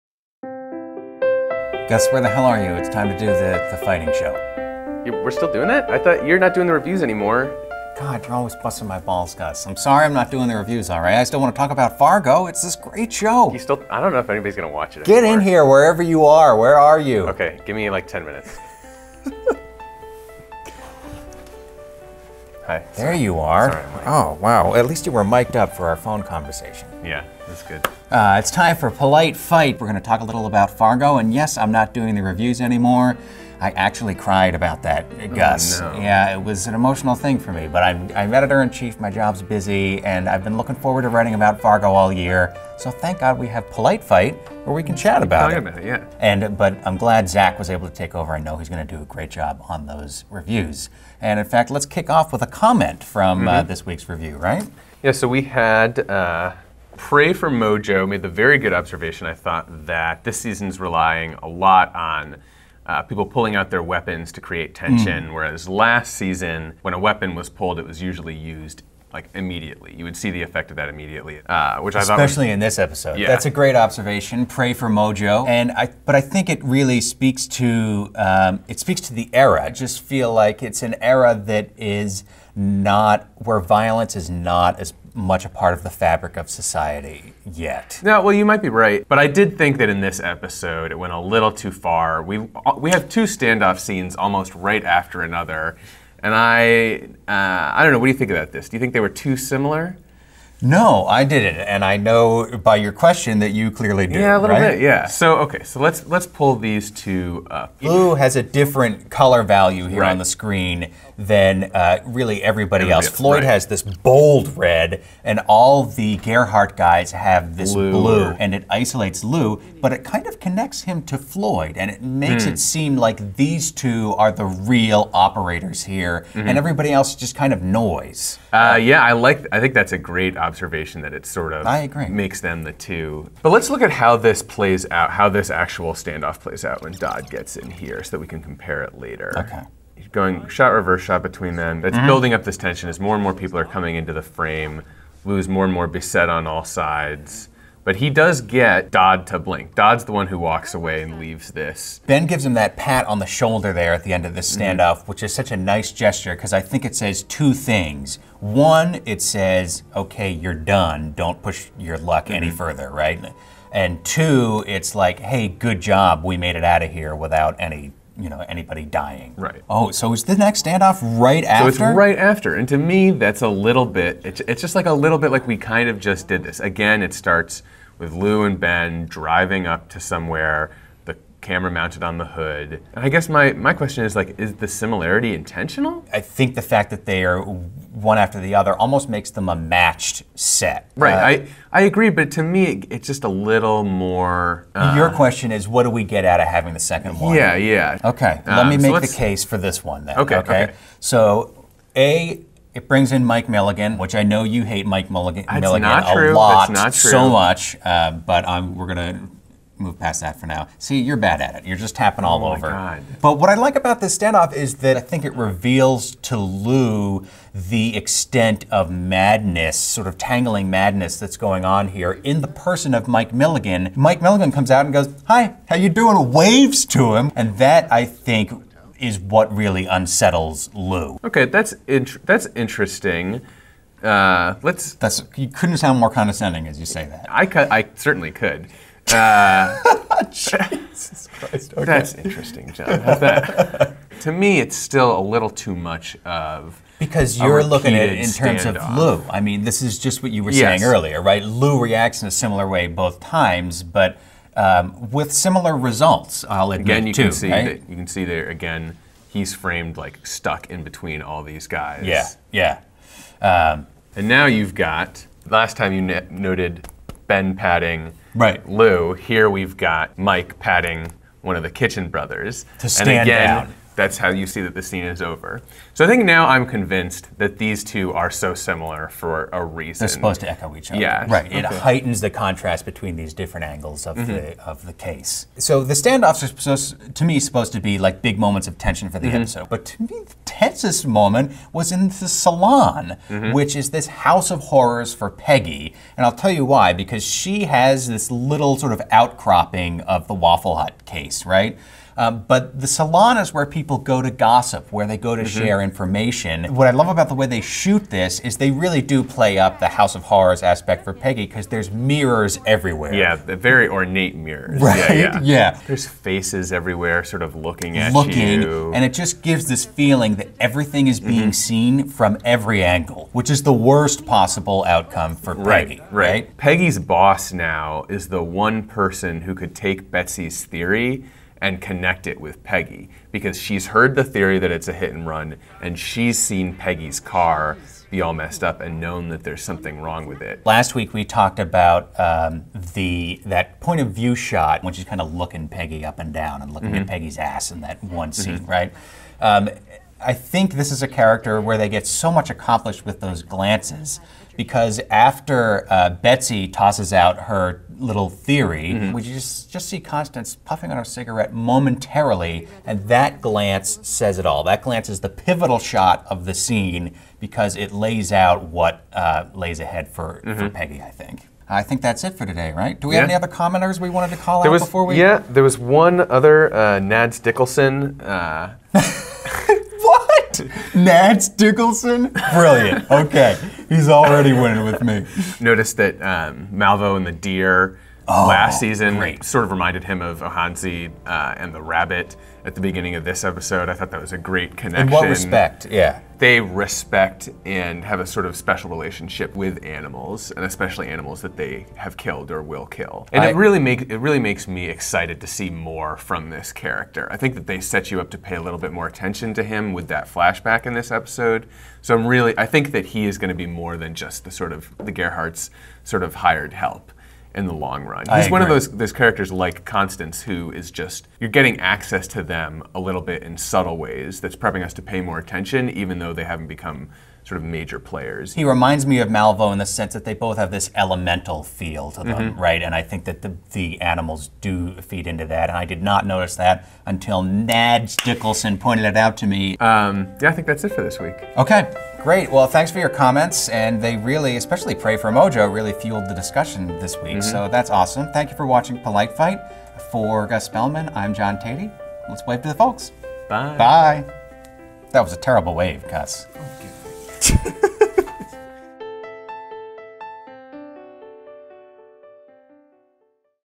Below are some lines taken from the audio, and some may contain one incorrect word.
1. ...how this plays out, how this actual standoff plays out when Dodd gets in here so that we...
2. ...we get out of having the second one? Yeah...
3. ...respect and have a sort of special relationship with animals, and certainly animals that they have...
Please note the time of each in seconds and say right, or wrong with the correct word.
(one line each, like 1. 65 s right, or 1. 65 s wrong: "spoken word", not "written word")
1. 133 s right
2. 195 s right
3. 396 s wrong: "especially", not "certainly".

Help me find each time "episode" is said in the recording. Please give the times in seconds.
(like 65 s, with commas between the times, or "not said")
72 s, 90 s, 289 s, 393 s, 411 s.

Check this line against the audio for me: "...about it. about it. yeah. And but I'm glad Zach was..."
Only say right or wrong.
right.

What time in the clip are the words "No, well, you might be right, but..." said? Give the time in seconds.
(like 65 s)
88 s.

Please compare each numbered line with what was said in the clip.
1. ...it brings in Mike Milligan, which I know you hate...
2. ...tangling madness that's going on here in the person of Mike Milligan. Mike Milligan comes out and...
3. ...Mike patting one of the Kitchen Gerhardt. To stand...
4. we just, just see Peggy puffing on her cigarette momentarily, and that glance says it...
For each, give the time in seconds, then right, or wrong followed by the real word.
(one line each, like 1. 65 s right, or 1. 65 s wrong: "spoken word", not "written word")
1. 202 s right
2. 220 s right
3. 270 s wrong: "Brothers", not "Gerhardt"
4. 359 s wrong: "Constance", not "Peggy".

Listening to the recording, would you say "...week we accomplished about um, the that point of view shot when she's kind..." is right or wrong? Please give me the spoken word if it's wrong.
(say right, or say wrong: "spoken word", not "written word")
wrong: "talked", not "accomplished".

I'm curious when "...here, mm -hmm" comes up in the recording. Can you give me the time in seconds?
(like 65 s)
125 s.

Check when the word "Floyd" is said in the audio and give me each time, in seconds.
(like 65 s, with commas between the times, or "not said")
113 s, 121 s.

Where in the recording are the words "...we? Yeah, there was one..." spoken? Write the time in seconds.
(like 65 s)
375 s.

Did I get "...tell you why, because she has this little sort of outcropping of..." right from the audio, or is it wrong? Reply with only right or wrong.
right.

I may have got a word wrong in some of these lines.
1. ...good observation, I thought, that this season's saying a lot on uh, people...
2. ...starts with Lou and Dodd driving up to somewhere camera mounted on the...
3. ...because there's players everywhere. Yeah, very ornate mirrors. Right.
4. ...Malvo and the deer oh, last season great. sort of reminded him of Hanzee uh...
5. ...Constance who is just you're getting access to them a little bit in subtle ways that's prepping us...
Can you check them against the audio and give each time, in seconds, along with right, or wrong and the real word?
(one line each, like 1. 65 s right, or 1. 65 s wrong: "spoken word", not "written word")
1. 58 s wrong: "relying", not "saying"
2. 177 s wrong: "Ben", not "Dodd"
3. 311 s wrong: "mirrors", not "players"
4. 386 s right
5. 419 s right.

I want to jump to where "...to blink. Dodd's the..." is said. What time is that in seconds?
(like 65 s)
149 s.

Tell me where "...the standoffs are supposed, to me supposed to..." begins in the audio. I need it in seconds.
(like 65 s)
285 s.